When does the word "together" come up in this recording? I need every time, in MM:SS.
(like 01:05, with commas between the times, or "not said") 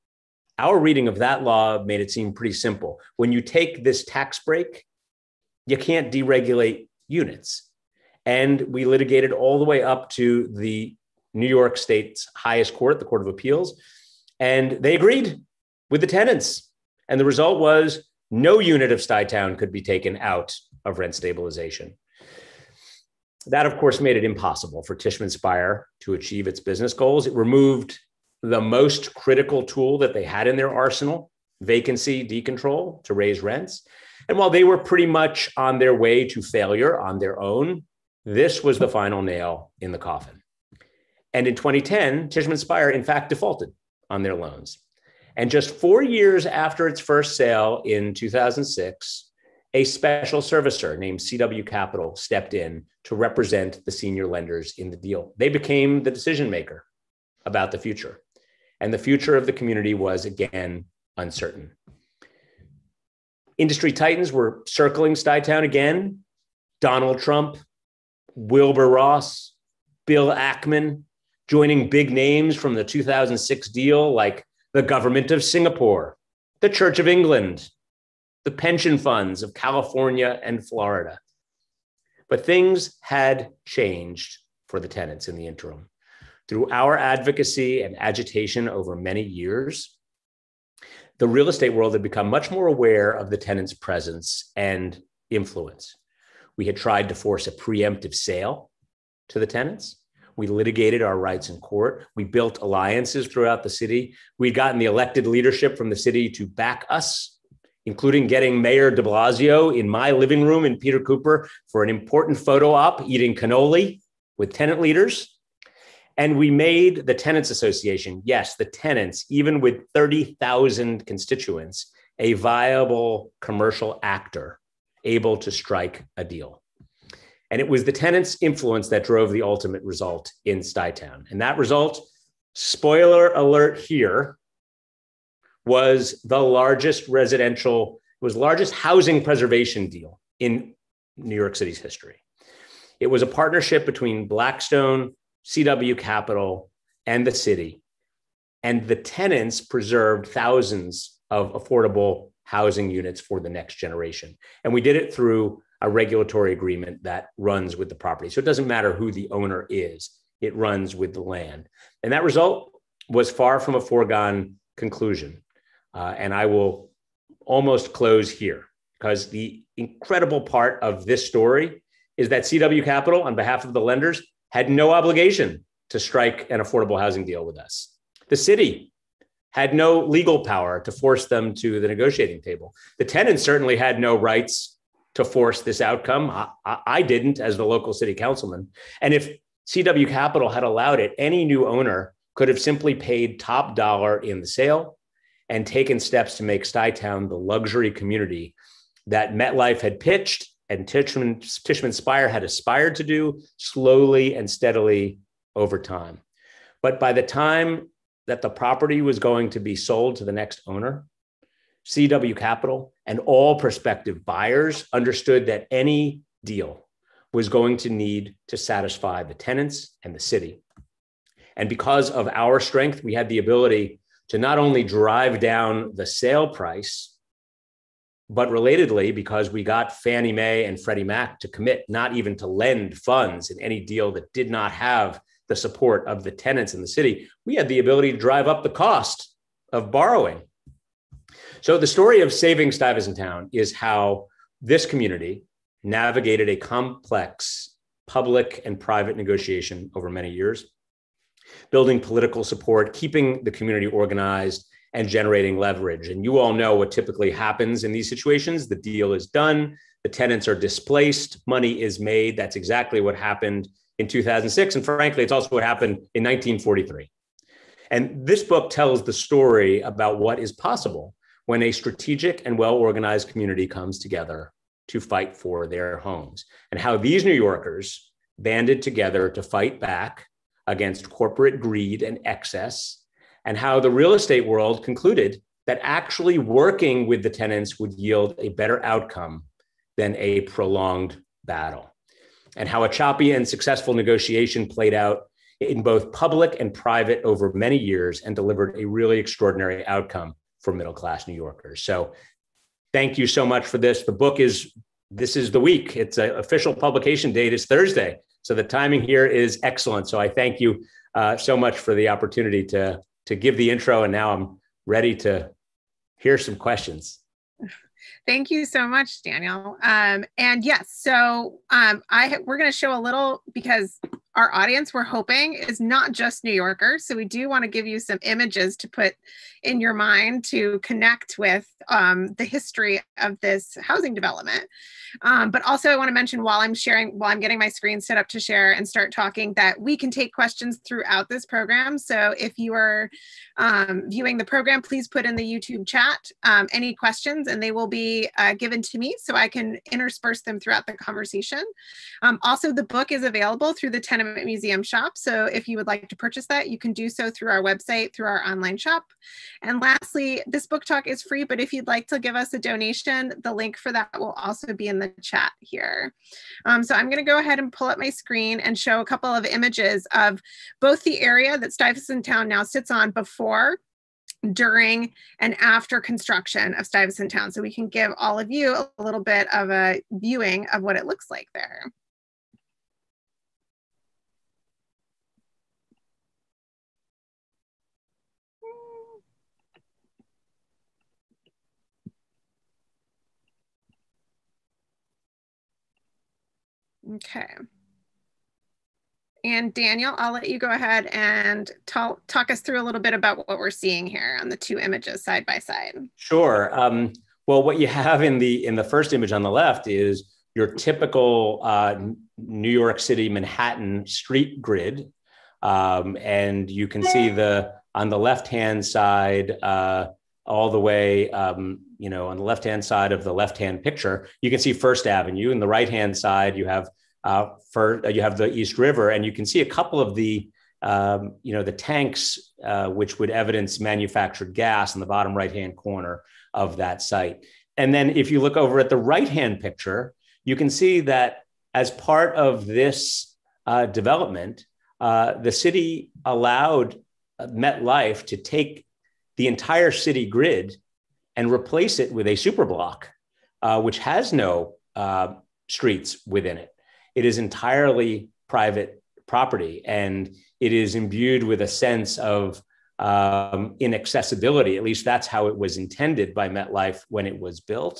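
04:33, 04:38.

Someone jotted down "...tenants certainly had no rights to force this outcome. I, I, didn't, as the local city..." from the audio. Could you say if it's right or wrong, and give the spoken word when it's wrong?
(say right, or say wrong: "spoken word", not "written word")
right.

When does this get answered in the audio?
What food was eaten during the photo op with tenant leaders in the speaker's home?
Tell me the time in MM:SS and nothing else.
01:53.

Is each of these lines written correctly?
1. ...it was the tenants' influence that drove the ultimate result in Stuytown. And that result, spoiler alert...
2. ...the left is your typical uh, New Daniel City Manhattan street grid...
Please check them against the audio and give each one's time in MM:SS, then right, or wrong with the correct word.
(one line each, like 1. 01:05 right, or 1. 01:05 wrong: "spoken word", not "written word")
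1. 02:07 right
2. 06:49 wrong: "York", not "Daniel".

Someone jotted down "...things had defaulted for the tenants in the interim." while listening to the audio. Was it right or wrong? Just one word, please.
wrong.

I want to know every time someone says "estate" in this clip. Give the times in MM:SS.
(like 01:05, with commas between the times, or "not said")
01:31, 04:44.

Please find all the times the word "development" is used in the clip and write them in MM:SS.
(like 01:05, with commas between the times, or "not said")
05:34, 07:23.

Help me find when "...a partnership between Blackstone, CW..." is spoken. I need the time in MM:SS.
02:23.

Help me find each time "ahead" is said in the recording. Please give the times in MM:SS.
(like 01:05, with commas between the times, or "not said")
06:07, 06:40.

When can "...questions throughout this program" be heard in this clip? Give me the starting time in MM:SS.
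05:40.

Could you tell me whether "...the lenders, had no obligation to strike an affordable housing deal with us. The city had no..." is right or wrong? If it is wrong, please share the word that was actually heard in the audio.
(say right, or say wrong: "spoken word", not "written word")
right.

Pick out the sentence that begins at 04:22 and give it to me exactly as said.
That's exactly what happened in 2006.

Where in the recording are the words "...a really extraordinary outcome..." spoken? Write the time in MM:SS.
04:58.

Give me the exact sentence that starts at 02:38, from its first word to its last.
So it doesn't matter who the owner is, it runs with the land.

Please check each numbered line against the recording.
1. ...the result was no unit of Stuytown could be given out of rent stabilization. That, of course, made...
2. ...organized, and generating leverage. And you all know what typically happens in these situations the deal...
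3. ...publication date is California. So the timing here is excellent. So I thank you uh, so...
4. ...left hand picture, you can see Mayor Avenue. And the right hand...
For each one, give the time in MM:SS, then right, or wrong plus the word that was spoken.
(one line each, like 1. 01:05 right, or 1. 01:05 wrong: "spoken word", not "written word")
1. 00:17 wrong: "taken", not "given"
2. 04:13 right
3. 05:06 wrong: "Thursday", not "California"
4. 07:03 wrong: "First", not "Mayor".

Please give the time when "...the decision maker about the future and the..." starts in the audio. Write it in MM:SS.
00:56.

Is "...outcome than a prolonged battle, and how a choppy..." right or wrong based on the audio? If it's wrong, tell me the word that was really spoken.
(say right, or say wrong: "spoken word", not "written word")
right.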